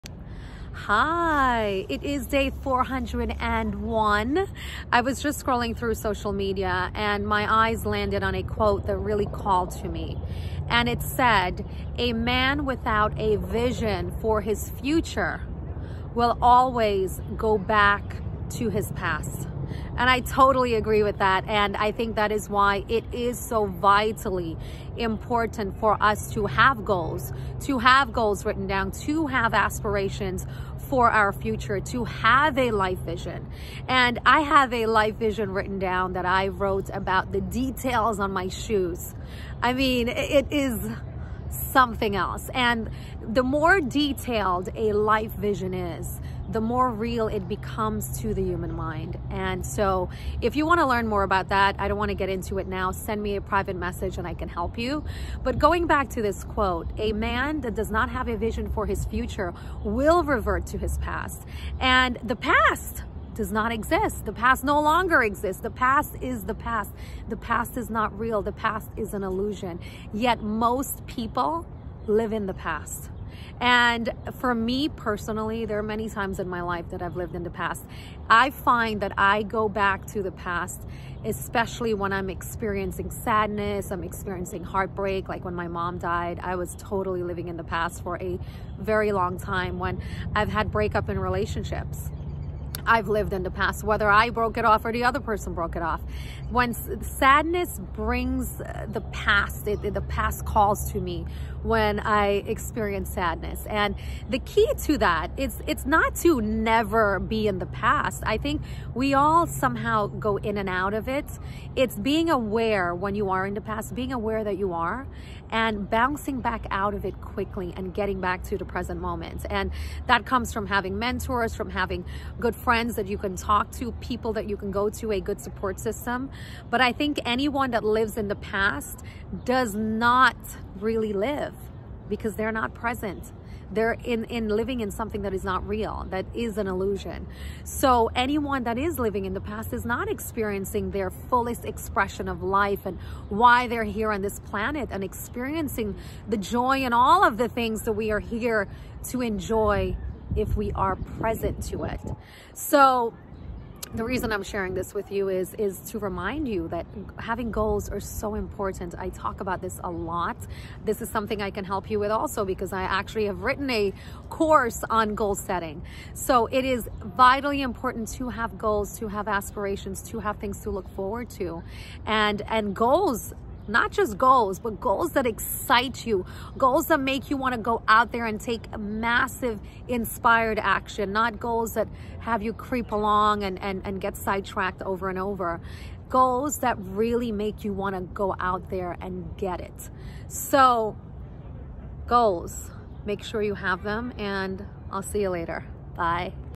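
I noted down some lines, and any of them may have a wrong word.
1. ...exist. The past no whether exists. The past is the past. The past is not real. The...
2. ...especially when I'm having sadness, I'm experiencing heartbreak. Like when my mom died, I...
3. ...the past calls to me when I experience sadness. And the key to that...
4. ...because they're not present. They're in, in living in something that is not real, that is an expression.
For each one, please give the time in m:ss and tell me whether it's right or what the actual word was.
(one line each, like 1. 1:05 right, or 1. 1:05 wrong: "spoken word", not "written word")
1. 1:03 wrong: "longer", not "whether"
2. 1:21 wrong: "experiencing", not "having"
3. 1:39 right
4. 2:12 wrong: "illusion", not "expression".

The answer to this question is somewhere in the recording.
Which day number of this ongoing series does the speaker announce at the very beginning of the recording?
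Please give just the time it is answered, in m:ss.
0:02.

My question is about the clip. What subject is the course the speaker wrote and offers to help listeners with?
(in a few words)
Goal setting.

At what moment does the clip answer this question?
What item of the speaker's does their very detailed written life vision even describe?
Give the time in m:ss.
0:38.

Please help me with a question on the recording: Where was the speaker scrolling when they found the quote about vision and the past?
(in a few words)
Social media.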